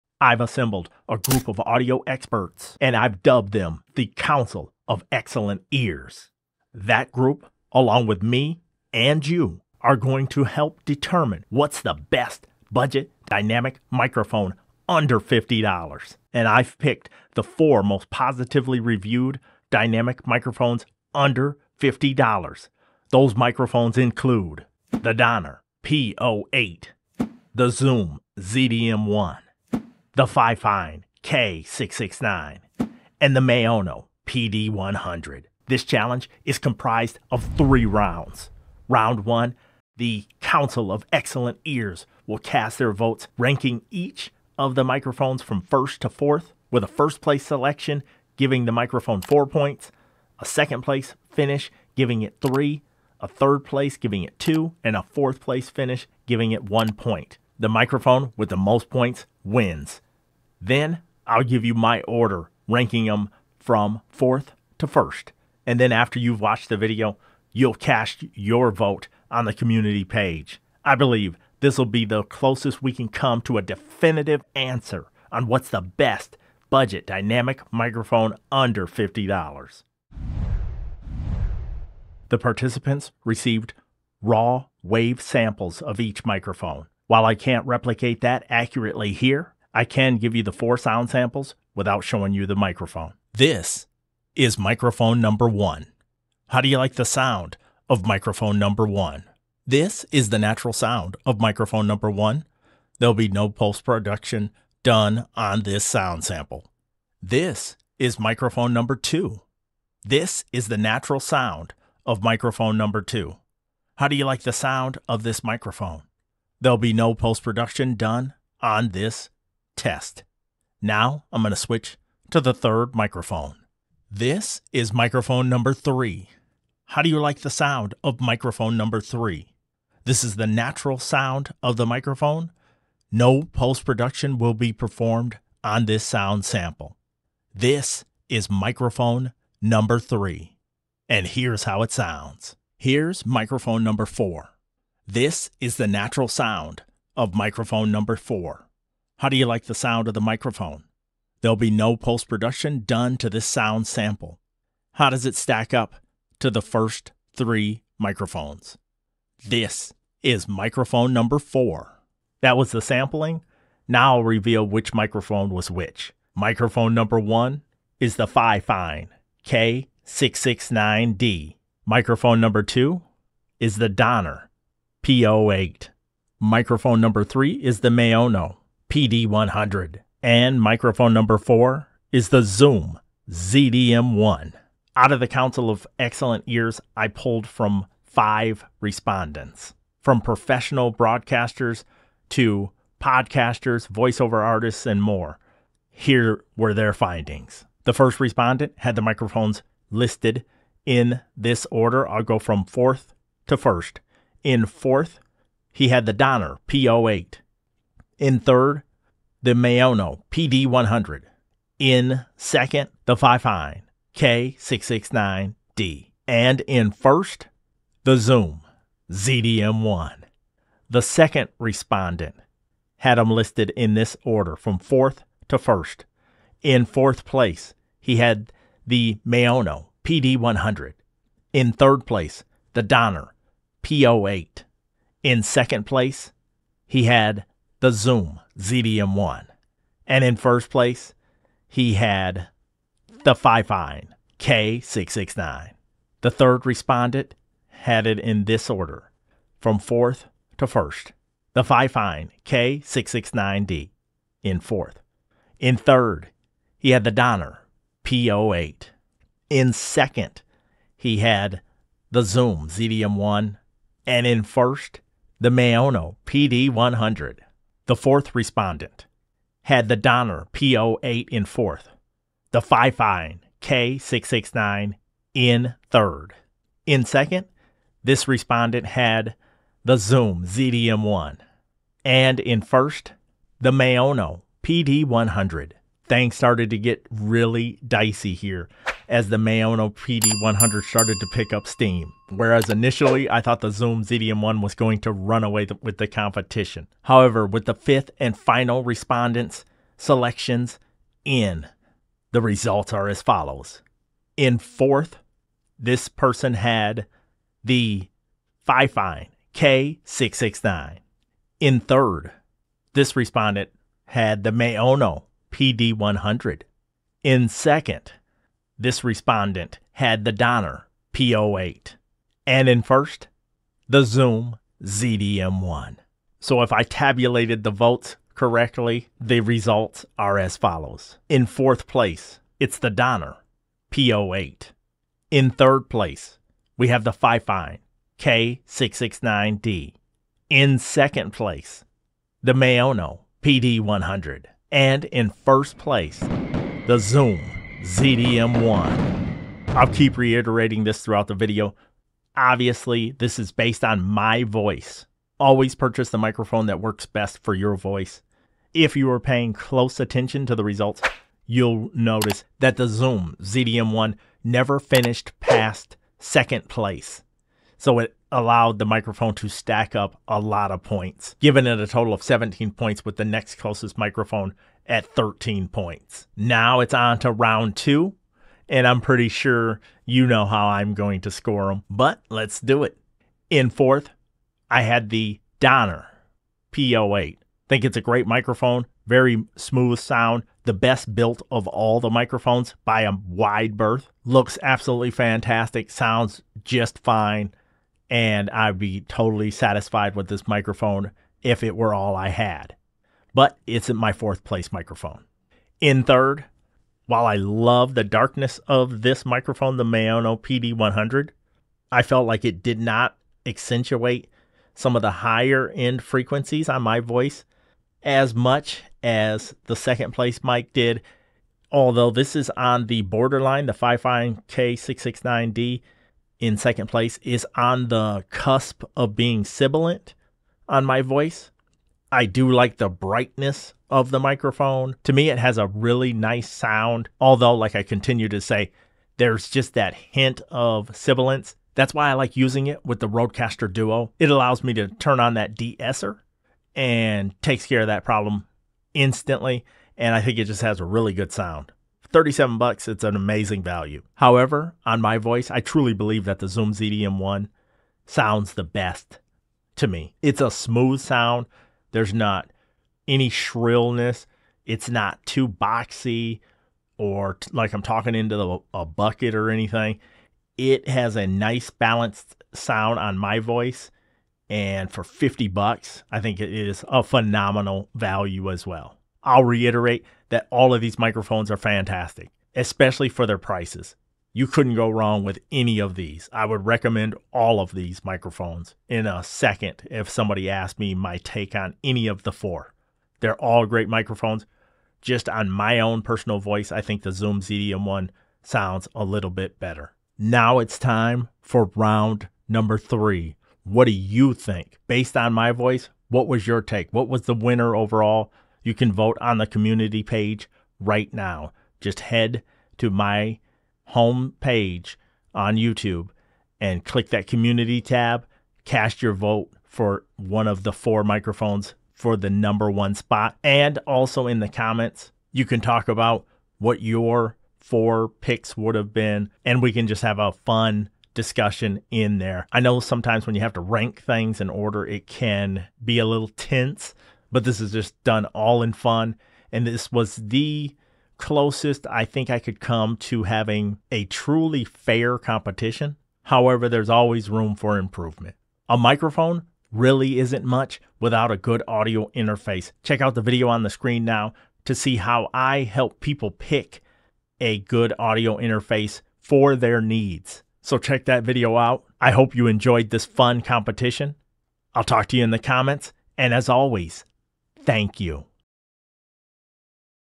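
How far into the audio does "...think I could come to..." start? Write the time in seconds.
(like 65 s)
542 s.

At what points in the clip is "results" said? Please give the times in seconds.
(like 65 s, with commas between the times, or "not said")
302 s, 329 s, 360 s.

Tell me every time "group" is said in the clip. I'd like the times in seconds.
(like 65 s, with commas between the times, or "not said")
1 s, 7 s.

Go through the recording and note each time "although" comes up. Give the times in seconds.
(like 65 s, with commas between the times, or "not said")
421 s, 437 s.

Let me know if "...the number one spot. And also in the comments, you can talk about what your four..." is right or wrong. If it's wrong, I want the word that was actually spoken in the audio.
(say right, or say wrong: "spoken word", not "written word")
right.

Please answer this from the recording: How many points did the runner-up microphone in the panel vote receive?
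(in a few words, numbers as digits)
13.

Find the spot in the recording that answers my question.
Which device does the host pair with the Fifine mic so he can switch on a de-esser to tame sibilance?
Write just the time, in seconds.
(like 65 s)
443 s.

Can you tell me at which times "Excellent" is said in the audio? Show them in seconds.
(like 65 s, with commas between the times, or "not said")
5 s, 41 s, 185 s.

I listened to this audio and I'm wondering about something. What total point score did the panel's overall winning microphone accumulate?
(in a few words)
17.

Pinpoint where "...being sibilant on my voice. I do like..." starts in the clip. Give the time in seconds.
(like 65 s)
429 s.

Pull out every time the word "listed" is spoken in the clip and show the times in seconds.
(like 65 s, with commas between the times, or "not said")
199 s, 223 s.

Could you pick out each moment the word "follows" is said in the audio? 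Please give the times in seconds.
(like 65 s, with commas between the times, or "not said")
303 s, 330 s.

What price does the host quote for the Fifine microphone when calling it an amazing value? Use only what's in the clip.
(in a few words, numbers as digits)
$37.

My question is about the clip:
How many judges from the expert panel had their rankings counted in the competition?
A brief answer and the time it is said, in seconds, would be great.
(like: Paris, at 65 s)
5, at 188 s.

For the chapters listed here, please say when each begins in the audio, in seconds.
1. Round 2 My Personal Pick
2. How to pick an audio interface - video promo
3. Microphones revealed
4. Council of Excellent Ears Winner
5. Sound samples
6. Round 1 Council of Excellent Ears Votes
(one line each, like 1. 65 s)
1. 375 s
2. 548 s
3. 165 s
4. 330 s
5. 80 s
6. 195 s.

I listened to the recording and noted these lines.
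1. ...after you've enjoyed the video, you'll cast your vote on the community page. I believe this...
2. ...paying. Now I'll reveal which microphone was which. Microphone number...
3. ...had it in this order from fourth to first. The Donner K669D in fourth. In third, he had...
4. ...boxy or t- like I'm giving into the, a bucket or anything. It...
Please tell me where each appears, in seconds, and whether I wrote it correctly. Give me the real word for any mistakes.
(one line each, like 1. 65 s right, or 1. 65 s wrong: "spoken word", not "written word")
1. 65 s wrong: "watched", not "enjoyed"
2. 162 s wrong: "sampling", not "paying"
3. 247 s wrong: "Fifine", not "Donner"
4. 465 s wrong: "talking", not "giving".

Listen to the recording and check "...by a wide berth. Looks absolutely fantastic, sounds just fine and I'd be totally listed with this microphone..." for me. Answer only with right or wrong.
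wrong.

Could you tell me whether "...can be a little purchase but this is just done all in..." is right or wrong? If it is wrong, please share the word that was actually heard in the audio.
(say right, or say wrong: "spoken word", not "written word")
wrong: "tense", not "purchase".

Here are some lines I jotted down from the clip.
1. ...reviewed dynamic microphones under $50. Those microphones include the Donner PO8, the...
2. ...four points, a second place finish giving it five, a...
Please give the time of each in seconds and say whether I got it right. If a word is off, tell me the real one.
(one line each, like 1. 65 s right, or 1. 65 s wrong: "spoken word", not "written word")
1. 18 s right
2. 49 s wrong: "three", not "five".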